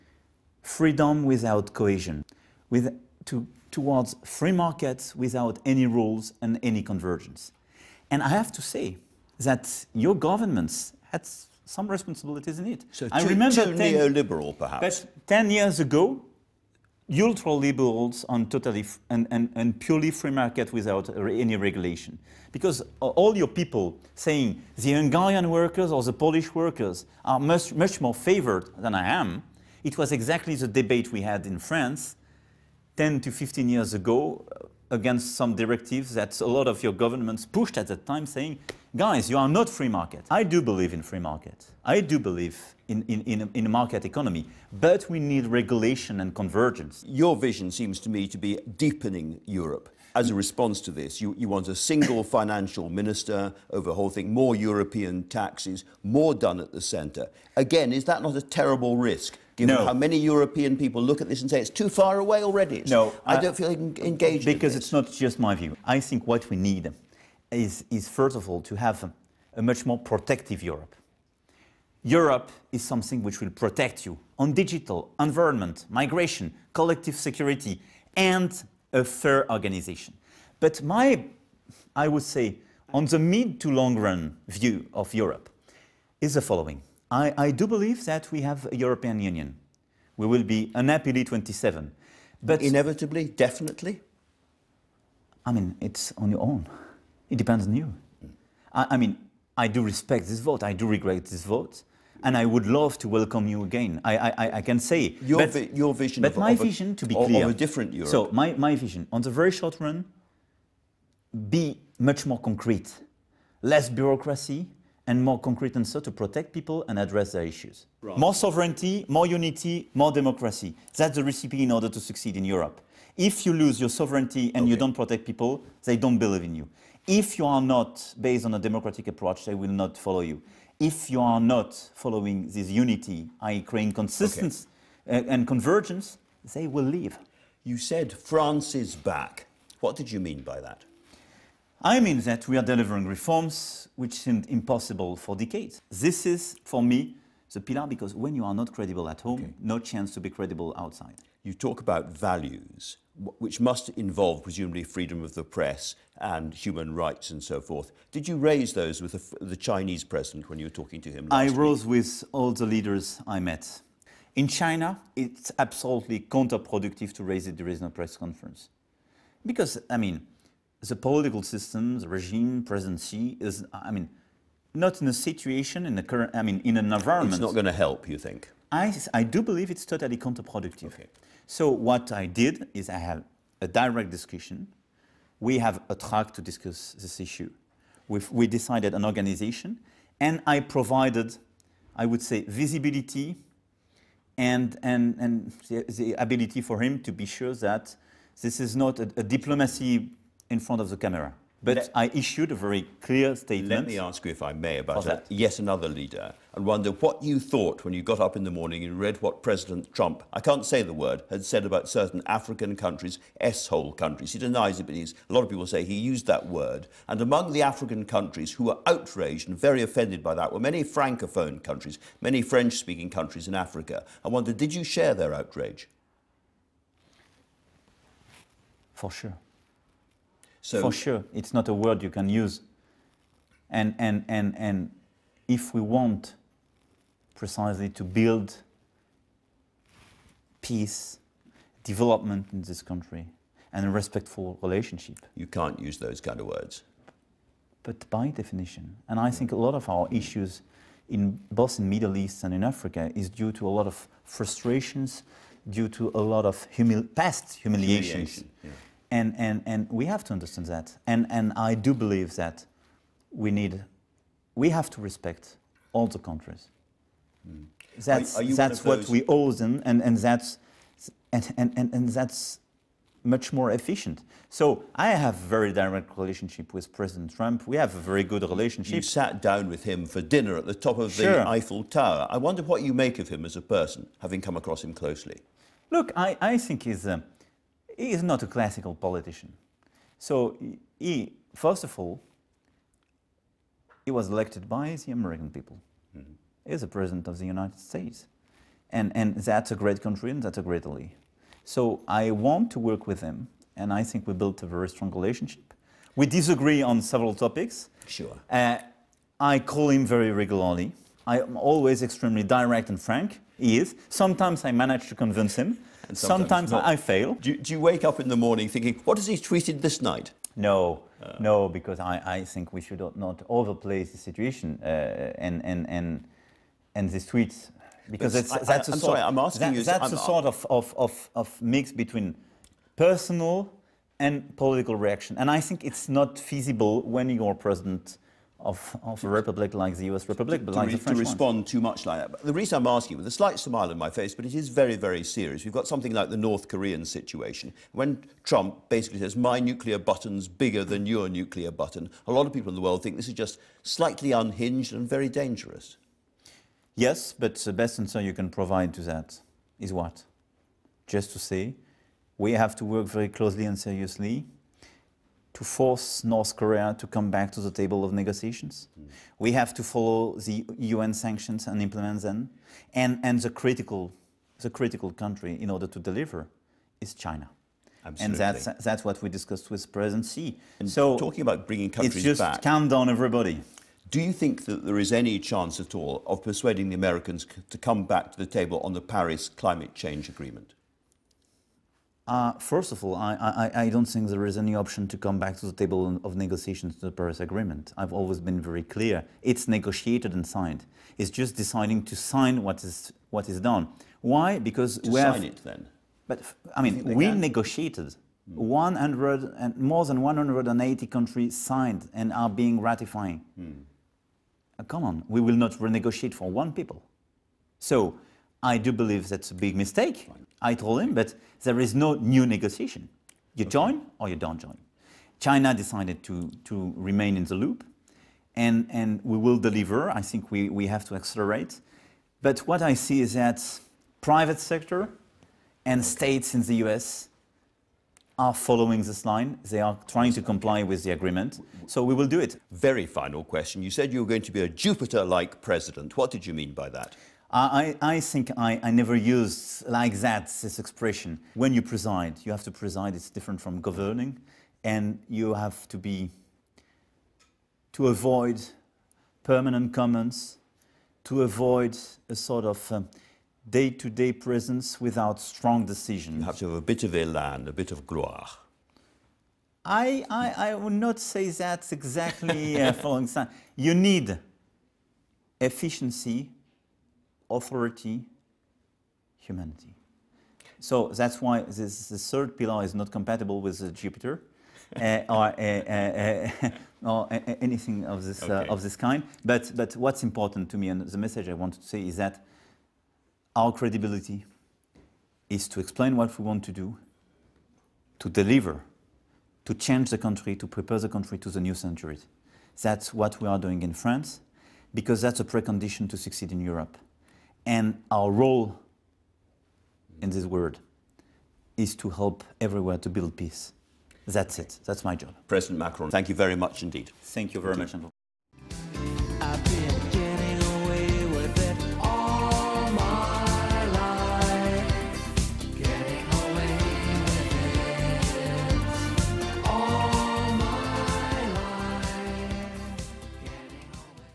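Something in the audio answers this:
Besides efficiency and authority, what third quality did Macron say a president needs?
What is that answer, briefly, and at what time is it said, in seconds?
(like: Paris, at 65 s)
humanity, at 479 s.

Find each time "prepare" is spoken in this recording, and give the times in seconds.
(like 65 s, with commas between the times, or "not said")
500 s.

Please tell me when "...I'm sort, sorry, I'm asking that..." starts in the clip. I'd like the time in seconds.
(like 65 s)
328 s.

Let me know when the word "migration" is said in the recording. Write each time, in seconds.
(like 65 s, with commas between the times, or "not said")
75 s.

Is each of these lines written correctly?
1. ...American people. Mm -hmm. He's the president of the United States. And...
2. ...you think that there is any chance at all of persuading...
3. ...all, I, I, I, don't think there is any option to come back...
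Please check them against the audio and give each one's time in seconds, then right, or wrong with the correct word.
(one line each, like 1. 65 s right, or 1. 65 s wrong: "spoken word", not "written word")
1. 295 s right
2. 384 s right
3. 393 s right.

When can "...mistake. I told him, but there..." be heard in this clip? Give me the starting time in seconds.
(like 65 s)
419 s.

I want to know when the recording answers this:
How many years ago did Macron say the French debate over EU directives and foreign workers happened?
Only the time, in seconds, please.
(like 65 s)
32 s.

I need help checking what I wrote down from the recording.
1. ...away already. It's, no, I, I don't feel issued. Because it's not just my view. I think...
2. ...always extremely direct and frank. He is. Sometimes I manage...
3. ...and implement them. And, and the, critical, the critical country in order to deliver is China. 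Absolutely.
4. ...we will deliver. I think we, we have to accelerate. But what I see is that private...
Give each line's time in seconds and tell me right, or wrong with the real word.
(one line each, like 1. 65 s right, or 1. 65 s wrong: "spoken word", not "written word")
1. 62 s wrong: "engaged", not "issued"
2. 311 s right
3. 371 s right
4. 429 s right.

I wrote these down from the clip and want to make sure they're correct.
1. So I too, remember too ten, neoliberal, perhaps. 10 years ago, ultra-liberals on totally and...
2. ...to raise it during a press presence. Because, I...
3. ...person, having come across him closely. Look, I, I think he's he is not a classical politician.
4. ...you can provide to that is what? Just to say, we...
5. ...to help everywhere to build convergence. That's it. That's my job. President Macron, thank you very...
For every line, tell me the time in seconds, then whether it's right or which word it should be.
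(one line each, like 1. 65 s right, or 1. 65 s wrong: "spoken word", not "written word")
1. 13 s right
2. 167 s wrong: "conference", not "presence"
3. 283 s right
4. 358 s right
5. 511 s wrong: "peace", not "convergence".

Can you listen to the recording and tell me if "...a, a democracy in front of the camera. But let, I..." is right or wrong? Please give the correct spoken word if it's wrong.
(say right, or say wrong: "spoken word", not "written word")
wrong: "diplomacy", not "democracy".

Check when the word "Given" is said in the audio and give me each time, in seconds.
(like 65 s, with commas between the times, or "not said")
59 s.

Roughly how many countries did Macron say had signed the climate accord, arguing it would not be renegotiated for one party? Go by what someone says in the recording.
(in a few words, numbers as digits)
more than 180.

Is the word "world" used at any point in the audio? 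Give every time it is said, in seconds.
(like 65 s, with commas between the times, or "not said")
352 s, 510 s.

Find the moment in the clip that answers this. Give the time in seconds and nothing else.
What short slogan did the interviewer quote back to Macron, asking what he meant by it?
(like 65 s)
138 s.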